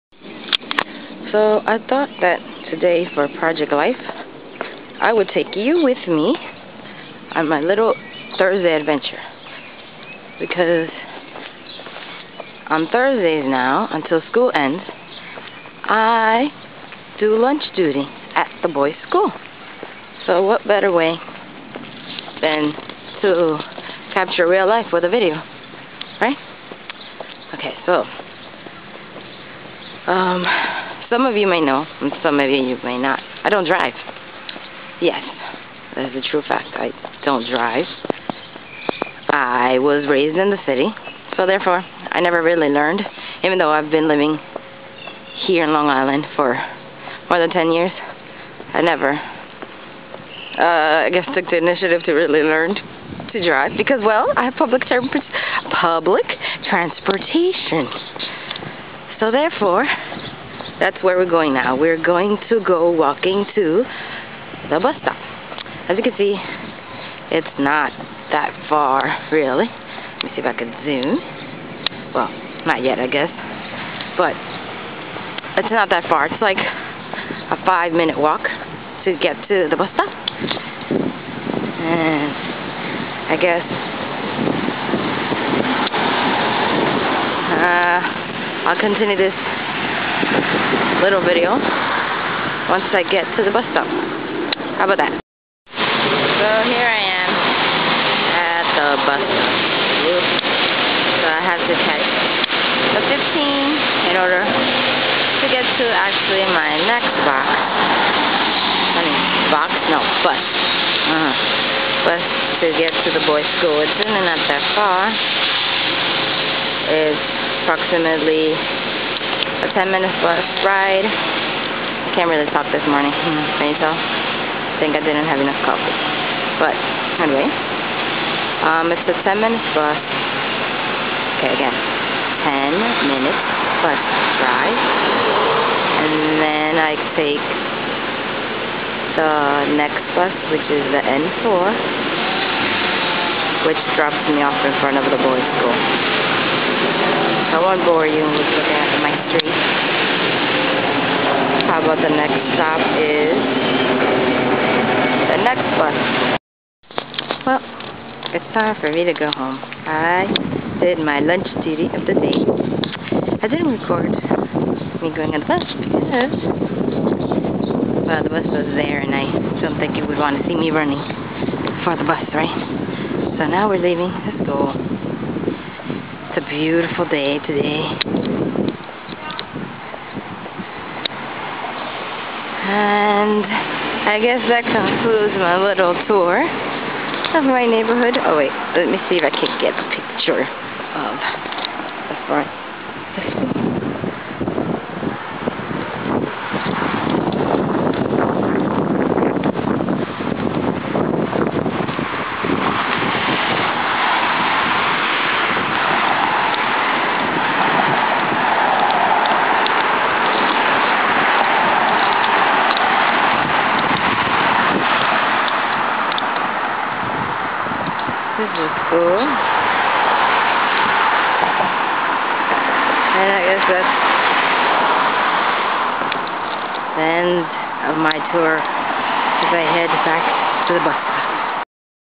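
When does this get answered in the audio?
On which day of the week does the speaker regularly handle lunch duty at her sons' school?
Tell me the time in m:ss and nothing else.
0:12.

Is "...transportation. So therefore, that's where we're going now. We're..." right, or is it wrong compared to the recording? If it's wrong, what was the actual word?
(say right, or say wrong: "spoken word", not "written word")
right.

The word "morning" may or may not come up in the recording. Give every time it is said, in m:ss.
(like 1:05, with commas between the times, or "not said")
2:02.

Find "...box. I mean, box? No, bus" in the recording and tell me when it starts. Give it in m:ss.
1:47.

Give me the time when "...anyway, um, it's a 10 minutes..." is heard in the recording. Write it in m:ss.
2:07.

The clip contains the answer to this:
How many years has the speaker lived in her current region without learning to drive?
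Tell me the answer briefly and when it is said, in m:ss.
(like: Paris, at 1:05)
more than 10, at 0:47.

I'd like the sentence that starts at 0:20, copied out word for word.
So what better way than to capture real life with a video, right?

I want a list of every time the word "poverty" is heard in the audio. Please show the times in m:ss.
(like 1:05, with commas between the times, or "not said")
not said.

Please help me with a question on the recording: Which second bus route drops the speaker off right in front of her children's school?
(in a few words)
N4.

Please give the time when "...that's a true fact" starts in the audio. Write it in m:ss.
0:35.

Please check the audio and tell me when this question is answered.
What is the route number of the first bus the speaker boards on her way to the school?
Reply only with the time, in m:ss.
1:43.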